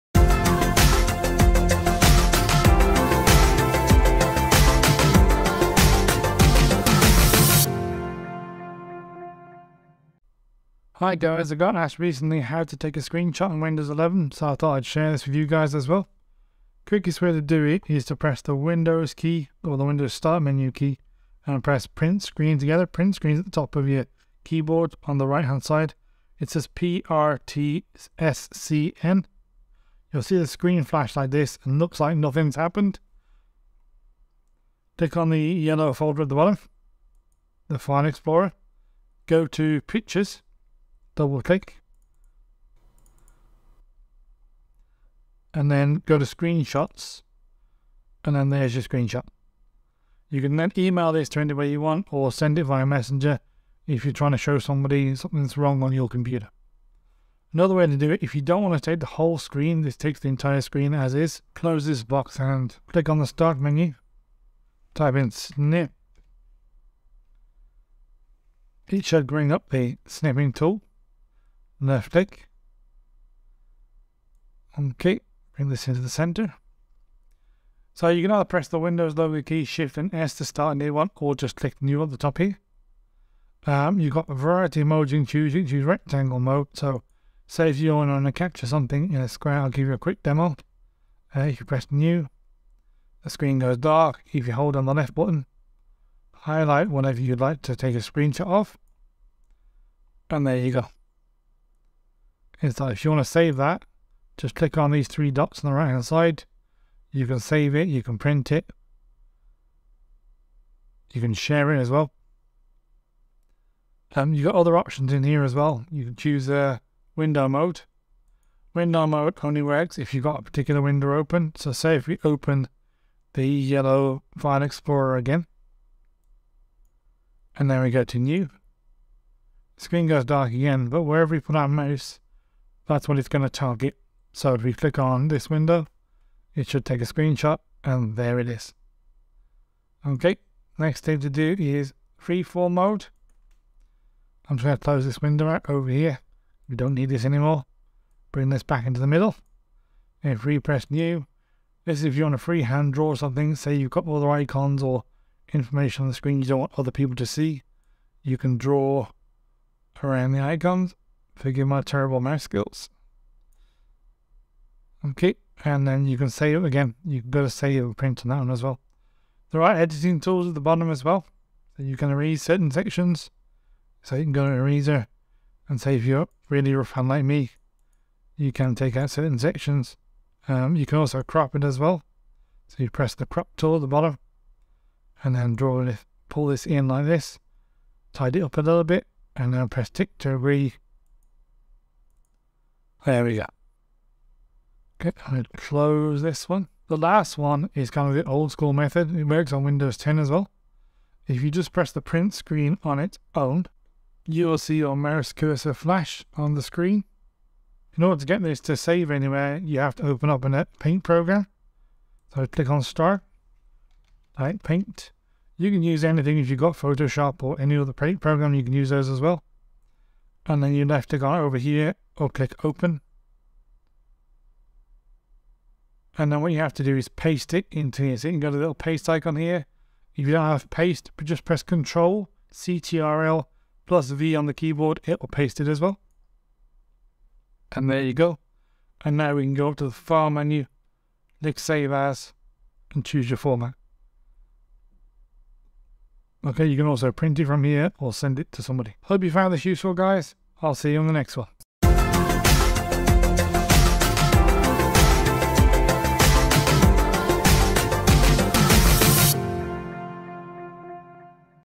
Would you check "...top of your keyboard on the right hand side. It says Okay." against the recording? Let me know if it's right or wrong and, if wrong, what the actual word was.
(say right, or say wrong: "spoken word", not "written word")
wrong: "PRTSCN", not "Okay".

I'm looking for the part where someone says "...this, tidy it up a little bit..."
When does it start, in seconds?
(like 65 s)
187 s.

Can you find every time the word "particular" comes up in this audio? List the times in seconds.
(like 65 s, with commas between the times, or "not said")
120 s.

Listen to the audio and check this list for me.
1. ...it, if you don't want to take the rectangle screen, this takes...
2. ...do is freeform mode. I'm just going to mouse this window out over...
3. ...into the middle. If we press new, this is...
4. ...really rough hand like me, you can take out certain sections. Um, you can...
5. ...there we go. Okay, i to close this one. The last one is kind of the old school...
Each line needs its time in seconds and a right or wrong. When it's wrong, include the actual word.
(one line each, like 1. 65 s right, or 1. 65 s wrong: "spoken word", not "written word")
1. 58 s wrong: "whole", not "rectangle"
2. 141 s wrong: "close", not "mouse"
3. 148 s right
4. 176 s right
5. 193 s right.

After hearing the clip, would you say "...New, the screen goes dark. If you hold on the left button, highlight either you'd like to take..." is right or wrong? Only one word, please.
wrong.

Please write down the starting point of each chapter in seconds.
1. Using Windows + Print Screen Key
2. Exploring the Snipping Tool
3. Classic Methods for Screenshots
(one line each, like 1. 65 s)
1. 16 s
2. 63 s
3. 196 s.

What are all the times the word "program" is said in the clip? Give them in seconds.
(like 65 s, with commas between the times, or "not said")
211 s, 218 s.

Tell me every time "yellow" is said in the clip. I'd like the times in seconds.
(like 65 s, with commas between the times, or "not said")
35 s, 123 s.